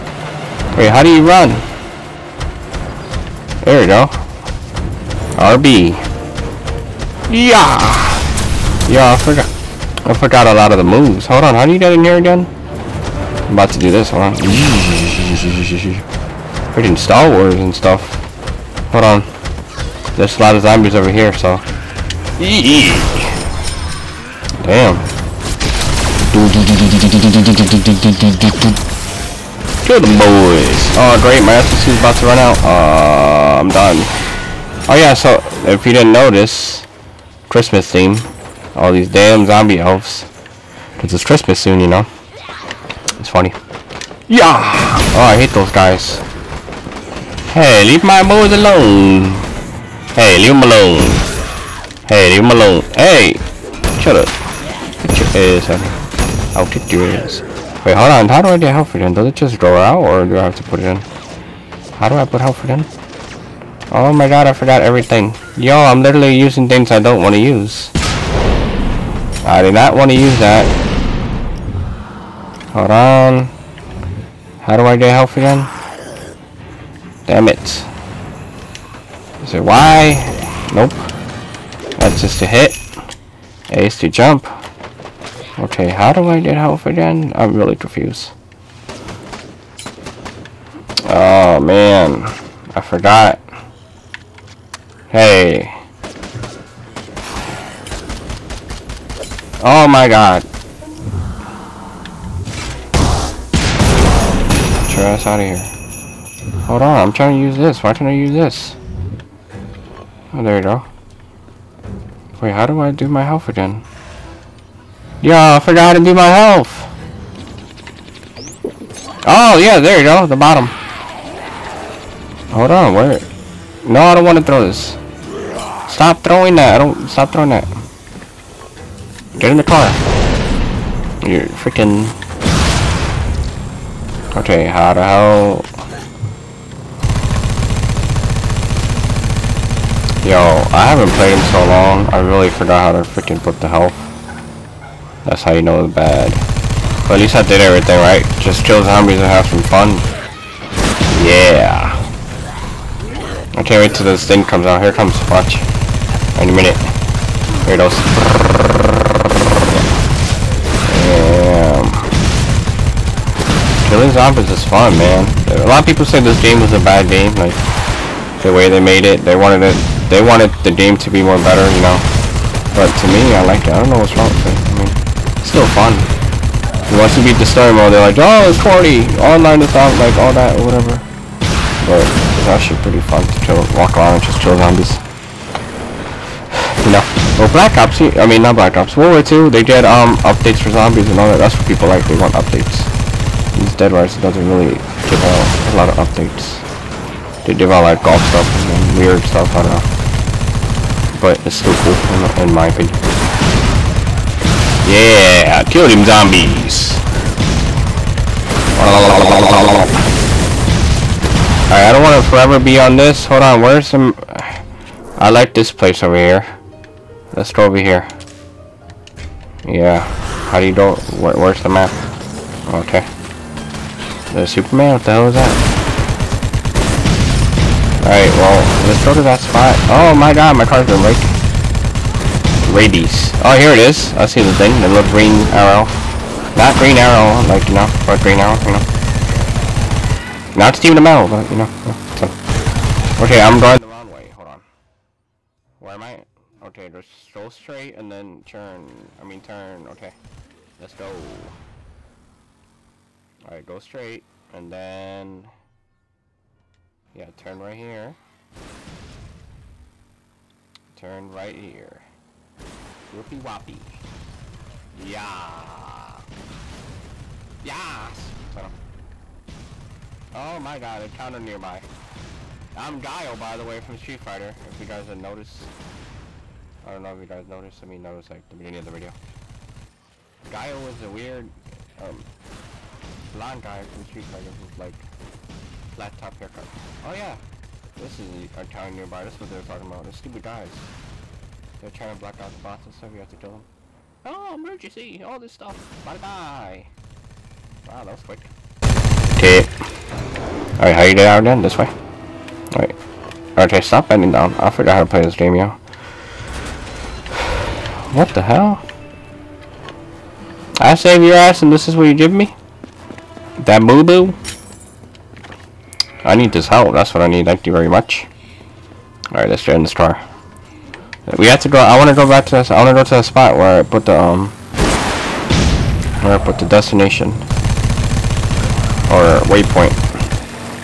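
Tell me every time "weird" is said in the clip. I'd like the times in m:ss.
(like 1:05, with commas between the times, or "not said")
3:18, 4:41.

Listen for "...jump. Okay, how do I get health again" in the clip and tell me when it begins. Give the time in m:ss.
1:24.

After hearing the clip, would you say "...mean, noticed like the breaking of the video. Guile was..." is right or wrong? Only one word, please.
wrong.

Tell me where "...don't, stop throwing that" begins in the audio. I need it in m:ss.
2:06.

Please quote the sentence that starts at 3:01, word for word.
But it's actually pretty fun to chill, walk around and just kill zombies.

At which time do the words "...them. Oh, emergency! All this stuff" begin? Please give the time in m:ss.
4:53.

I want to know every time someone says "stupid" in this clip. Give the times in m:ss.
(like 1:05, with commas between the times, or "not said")
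4:50.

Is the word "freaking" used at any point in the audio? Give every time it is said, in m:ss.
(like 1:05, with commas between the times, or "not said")
0:16, 2:11, 2:23.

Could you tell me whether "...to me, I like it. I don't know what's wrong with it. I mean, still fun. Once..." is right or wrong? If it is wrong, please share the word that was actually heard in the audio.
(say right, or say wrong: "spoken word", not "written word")
right.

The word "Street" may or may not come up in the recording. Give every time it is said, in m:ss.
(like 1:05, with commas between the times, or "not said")
4:34, 4:44.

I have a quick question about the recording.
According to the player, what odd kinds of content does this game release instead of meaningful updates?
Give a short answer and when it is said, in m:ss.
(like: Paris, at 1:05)
golf stuff, at 3:18.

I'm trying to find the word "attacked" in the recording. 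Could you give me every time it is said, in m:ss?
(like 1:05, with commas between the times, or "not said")
not said.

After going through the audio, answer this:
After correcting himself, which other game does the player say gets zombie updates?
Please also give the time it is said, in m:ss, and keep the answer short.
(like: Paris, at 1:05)
World War 2, at 3:08.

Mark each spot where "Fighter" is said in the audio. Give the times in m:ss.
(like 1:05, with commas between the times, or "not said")
4:34, 4:44.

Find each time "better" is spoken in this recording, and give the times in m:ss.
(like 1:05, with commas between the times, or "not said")
2:51.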